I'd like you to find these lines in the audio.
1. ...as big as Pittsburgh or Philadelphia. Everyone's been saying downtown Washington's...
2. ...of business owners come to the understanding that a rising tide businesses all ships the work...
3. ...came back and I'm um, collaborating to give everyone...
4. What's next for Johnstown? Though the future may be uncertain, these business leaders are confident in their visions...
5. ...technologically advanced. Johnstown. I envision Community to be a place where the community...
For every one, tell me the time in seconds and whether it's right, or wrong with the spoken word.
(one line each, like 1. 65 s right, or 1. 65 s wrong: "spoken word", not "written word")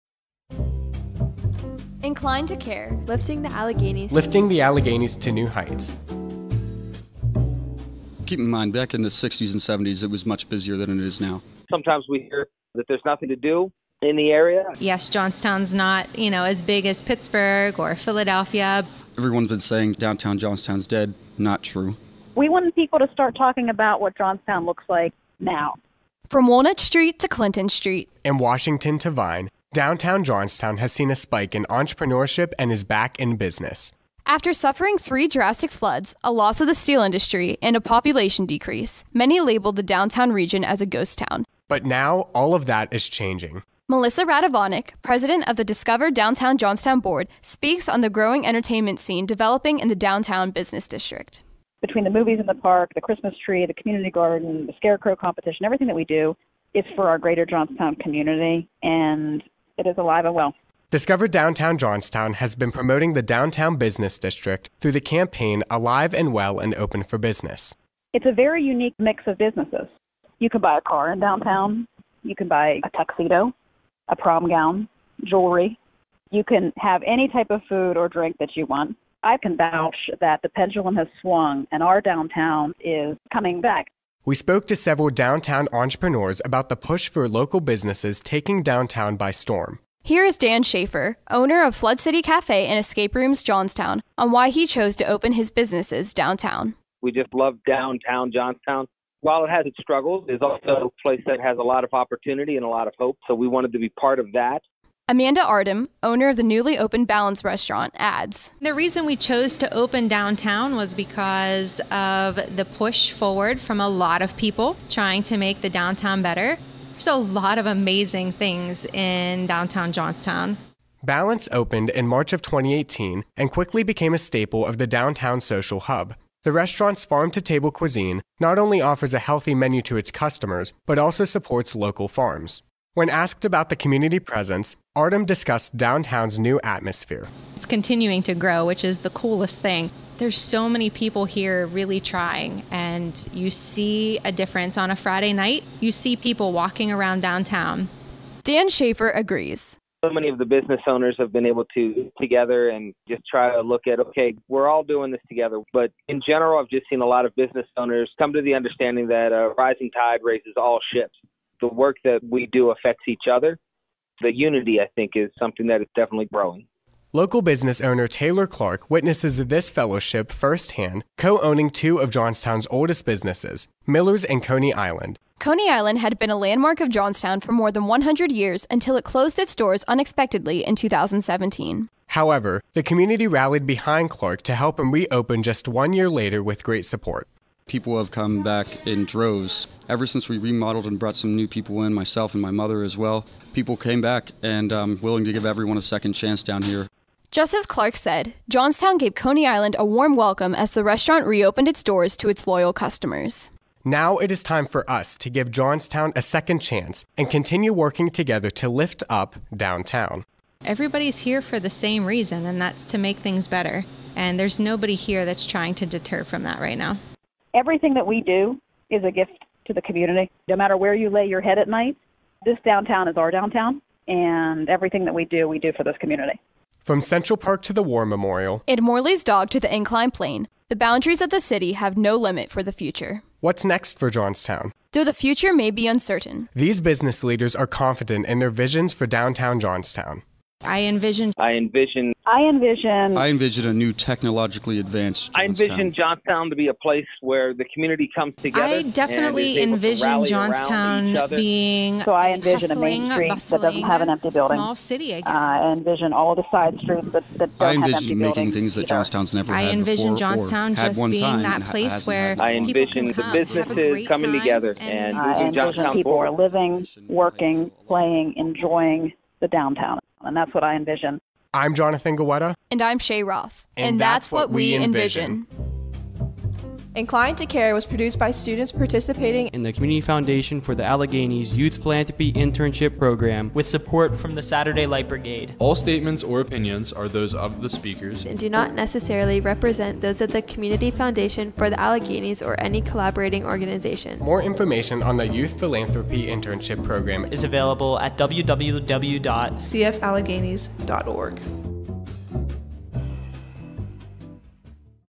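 1. 16 s wrong: "Johnstown", not "Washington"
2. 157 s wrong: "raises", not "businesses"
3. 193 s wrong: "willing", not "collaborating"
4. 233 s right
5. 243 s wrong: "Johnstown", not "Community".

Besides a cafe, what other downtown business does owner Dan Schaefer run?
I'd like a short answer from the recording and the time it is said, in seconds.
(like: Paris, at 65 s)
Escape Rooms Johnstown, at 92 s.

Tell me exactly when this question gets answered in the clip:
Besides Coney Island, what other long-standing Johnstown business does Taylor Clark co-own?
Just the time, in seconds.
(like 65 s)
173 s.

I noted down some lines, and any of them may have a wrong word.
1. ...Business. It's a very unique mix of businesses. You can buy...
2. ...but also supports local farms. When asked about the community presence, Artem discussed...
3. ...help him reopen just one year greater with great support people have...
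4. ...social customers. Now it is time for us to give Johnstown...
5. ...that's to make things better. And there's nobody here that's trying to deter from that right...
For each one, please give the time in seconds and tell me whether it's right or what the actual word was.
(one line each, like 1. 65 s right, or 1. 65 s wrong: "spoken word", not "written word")
1. 67 s right
2. 130 s right
3. 184 s wrong: "later", not "greater"
4. 202 s wrong: "loyal", not "social"
5. 212 s right.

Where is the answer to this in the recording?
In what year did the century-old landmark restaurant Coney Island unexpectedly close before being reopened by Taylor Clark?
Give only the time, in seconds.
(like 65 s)
180 s.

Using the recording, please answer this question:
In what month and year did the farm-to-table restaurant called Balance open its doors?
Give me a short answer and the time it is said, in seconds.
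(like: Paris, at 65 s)
March 2018, at 122 s.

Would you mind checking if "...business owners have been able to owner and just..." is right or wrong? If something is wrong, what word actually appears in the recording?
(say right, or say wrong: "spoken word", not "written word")
wrong: "together", not "owner".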